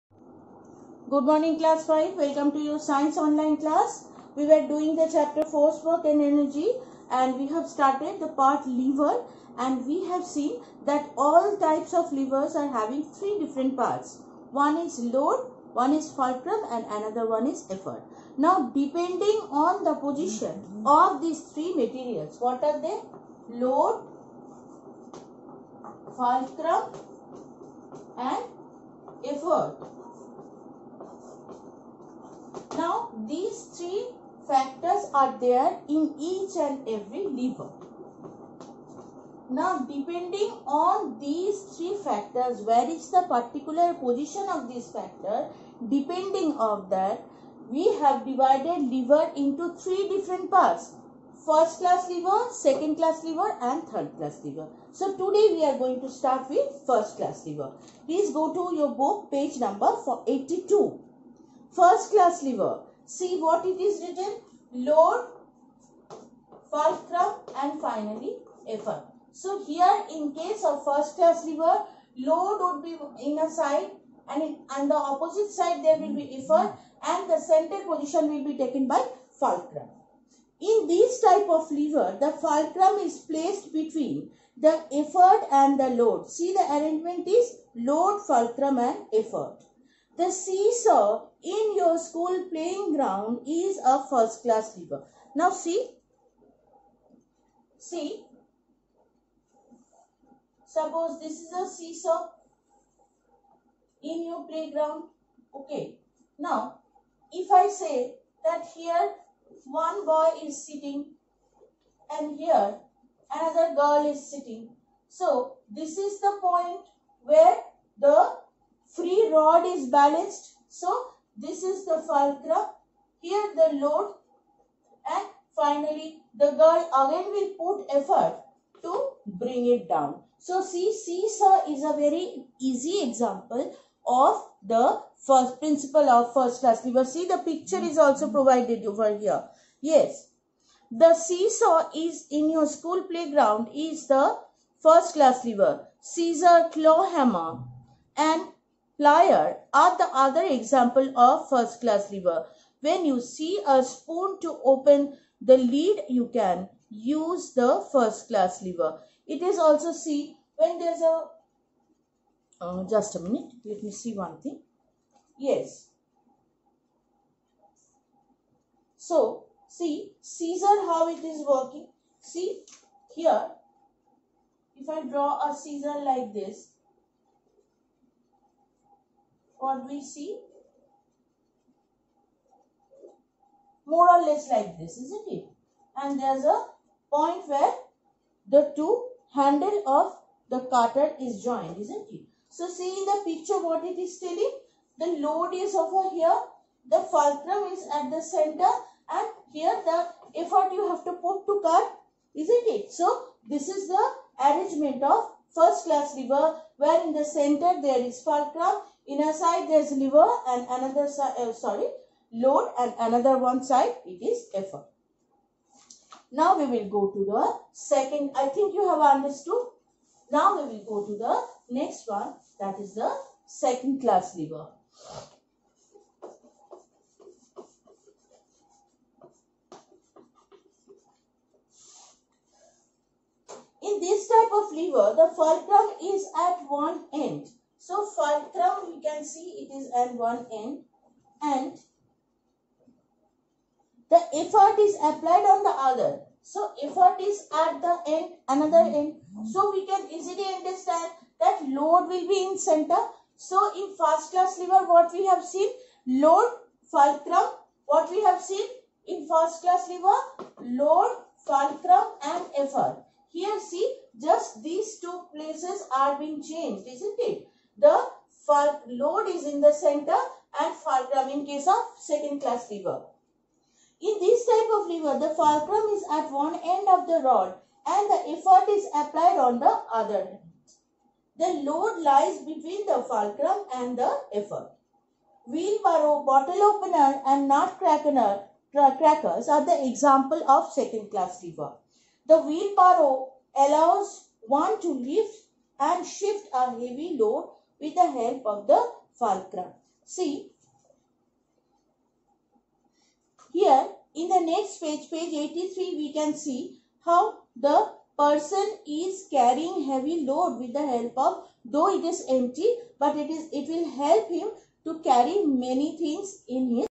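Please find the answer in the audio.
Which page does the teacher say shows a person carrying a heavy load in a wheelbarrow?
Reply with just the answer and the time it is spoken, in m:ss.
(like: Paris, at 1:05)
83, at 5:05.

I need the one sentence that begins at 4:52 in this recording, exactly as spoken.
The wheelbarrow allows one to lift and shift a heavy load with the help of the fulcrum.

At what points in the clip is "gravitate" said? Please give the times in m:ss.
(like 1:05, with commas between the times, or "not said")
not said.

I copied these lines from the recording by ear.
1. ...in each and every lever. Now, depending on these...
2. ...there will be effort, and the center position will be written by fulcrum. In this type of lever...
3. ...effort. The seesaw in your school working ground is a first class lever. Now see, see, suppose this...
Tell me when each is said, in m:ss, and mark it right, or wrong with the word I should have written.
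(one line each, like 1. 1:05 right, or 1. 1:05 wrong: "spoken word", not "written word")
1. 0:35 right
2. 1:15 wrong: "taken", not "written"
3. 1:29 wrong: "playing", not "working".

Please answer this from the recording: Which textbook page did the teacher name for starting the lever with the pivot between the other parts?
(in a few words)
82.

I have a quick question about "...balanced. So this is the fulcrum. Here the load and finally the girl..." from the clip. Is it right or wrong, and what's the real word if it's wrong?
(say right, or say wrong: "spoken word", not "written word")
right.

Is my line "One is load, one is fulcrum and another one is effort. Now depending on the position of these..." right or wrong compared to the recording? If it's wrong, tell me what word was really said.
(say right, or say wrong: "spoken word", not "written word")
right.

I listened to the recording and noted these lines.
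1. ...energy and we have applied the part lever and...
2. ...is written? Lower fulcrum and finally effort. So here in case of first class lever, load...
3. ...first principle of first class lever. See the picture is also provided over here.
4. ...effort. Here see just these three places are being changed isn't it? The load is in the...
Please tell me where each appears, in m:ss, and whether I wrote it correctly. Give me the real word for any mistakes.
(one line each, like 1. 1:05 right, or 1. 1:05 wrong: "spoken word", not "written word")
1. 0:06 wrong: "started", not "applied"
2. 1:03 right
3. 2:15 right
4. 4:22 wrong: "two", not "three".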